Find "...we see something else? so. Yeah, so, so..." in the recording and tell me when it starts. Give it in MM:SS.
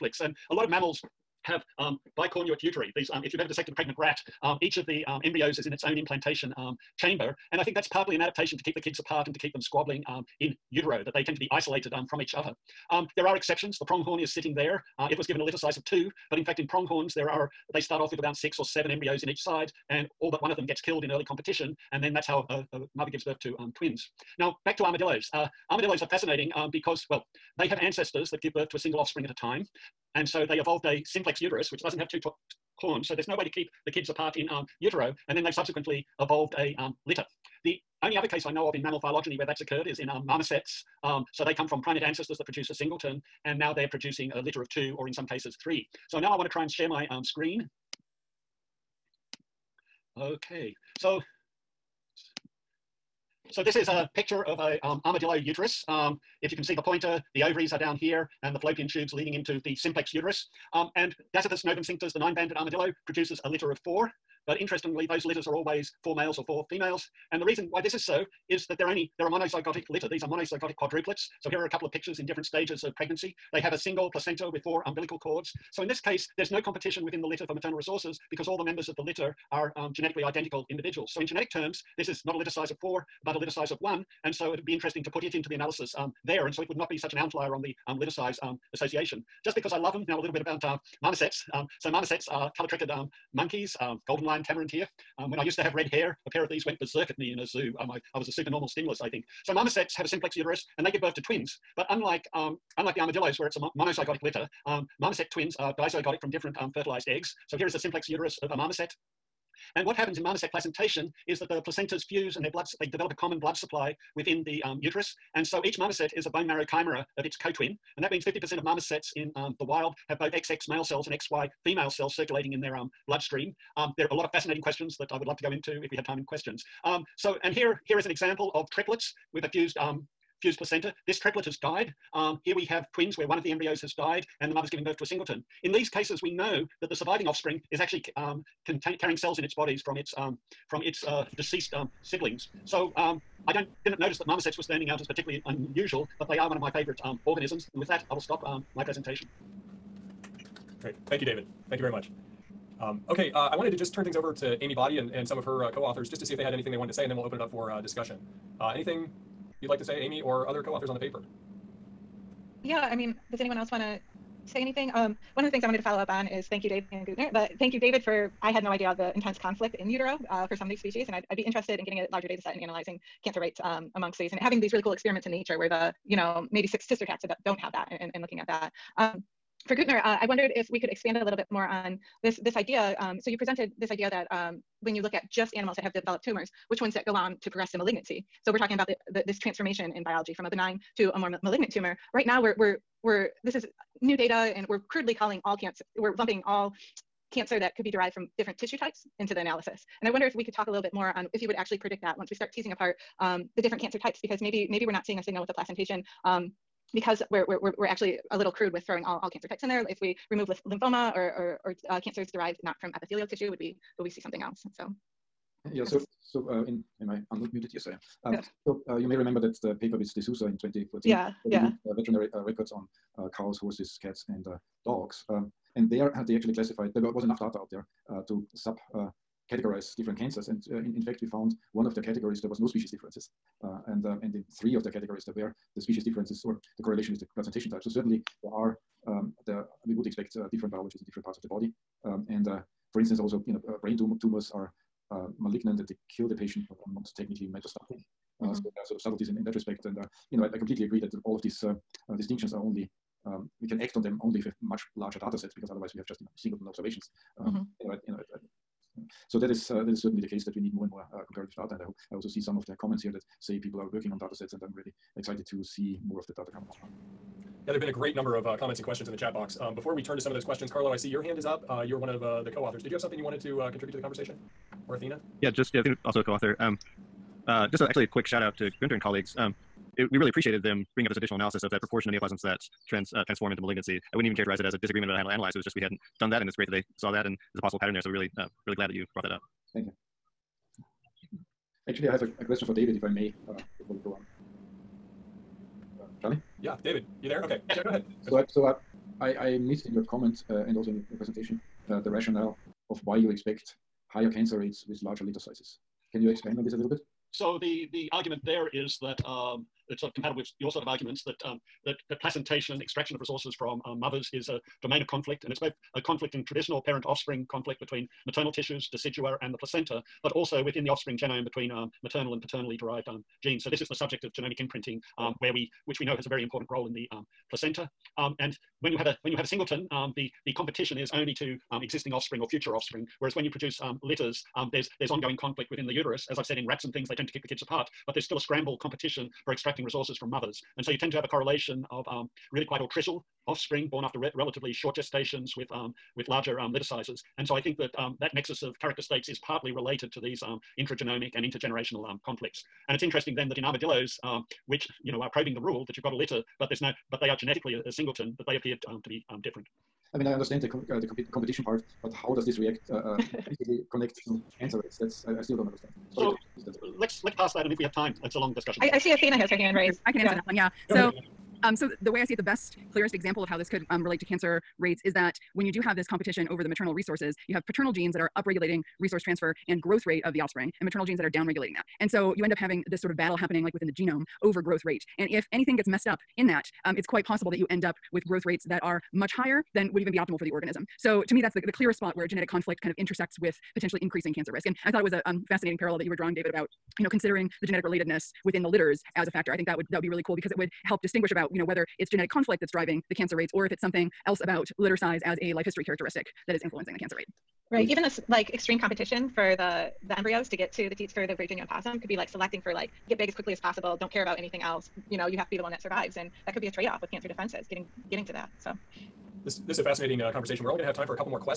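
03:34.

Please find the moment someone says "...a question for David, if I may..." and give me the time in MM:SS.
04:52.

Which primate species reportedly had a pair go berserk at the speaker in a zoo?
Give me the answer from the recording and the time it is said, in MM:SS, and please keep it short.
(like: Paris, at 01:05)
Golden lion tamarin, at 01:34.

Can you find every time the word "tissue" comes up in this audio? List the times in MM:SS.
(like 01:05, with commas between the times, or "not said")
03:18, 03:33, 05:18.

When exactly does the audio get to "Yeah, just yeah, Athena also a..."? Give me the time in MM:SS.
04:35.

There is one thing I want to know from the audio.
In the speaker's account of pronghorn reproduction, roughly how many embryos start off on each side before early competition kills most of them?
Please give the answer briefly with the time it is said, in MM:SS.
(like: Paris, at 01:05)
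6 or 7, at 00:18.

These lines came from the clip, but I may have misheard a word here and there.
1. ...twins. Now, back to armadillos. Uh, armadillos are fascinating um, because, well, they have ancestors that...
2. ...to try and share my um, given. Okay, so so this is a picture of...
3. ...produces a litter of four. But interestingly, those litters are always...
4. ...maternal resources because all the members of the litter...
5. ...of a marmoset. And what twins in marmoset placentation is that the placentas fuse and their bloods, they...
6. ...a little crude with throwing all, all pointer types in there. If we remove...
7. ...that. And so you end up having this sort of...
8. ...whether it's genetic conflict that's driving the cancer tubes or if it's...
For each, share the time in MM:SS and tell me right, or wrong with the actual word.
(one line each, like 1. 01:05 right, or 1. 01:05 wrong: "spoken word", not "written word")
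1. 00:23 right
2. 00:46 wrong: "screen", not "given"
3. 01:03 right
4. 01:17 right
5. 01:48 wrong: "happens", not "twins"
6. 03:28 wrong: "cancer", not "pointer"
7. 06:21 right
8. 06:41 wrong: "rates", not "tubes".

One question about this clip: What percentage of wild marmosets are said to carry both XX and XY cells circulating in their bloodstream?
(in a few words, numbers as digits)
50%.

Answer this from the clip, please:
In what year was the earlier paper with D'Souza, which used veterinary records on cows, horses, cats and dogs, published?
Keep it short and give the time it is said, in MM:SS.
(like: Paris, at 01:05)
2014, at 03:40.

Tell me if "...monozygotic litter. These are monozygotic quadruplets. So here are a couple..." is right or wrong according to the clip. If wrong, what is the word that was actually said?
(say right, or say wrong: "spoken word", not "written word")
right.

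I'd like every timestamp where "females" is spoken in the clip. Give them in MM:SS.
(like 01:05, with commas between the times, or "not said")
01:06, 02:01.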